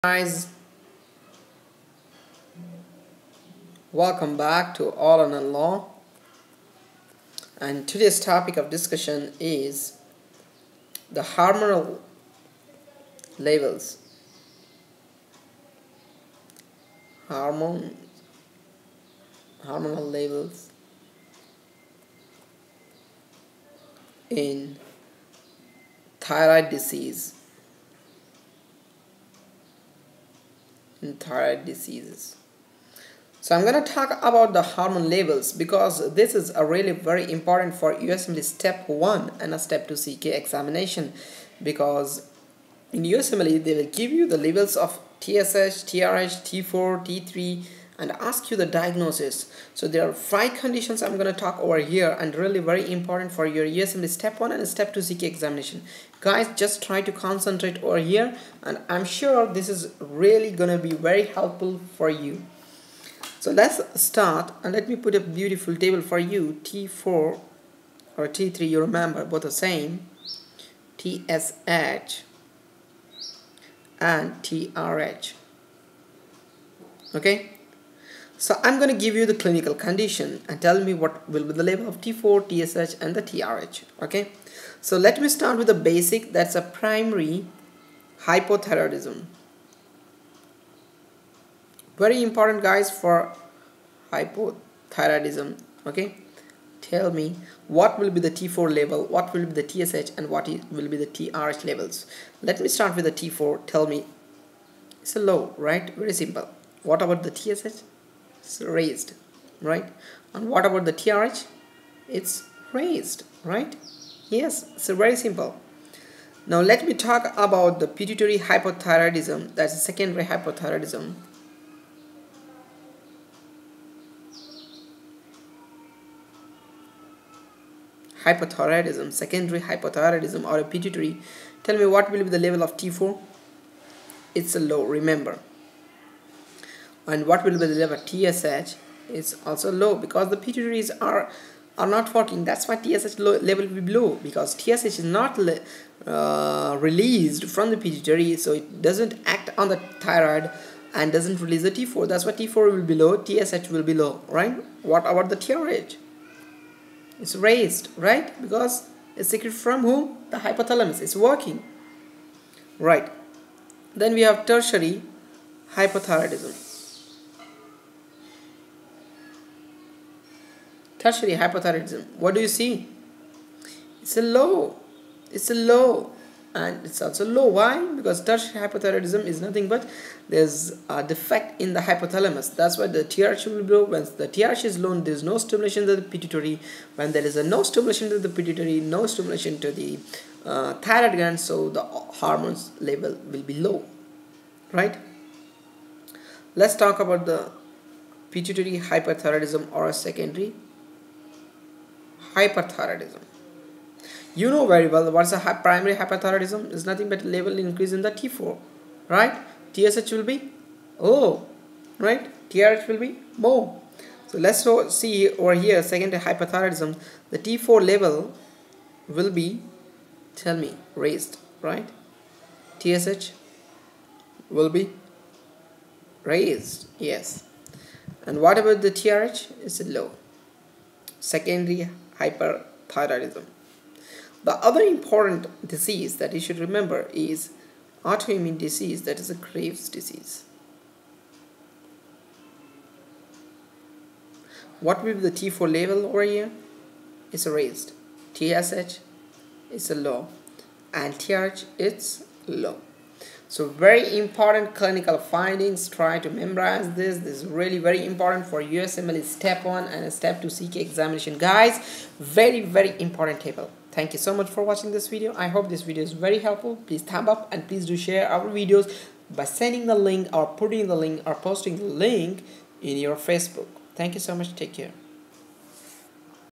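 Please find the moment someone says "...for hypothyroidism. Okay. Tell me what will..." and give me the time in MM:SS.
01:32.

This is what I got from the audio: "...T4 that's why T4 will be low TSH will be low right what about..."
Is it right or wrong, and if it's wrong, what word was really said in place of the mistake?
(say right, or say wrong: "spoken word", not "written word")
right.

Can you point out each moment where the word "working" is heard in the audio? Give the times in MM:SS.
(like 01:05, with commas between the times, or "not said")
02:22, 02:41.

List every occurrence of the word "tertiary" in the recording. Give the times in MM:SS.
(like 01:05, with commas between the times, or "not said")
02:44, 02:51, 02:58.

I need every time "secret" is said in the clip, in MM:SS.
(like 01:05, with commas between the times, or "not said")
02:39.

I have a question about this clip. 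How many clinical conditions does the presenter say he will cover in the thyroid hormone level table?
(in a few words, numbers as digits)
5.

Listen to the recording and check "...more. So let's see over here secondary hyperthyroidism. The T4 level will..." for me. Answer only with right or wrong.
right.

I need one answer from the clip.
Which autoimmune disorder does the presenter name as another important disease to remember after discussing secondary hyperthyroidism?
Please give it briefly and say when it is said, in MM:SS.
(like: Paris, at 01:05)
Graves' disease, at 03:59.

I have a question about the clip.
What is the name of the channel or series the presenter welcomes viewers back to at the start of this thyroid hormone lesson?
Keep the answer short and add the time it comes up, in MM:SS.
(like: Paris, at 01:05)
All or None Law, at 00:04.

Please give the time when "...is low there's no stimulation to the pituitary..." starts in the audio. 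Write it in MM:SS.
03:04.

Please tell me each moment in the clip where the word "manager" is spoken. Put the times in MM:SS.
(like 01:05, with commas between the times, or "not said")
not said.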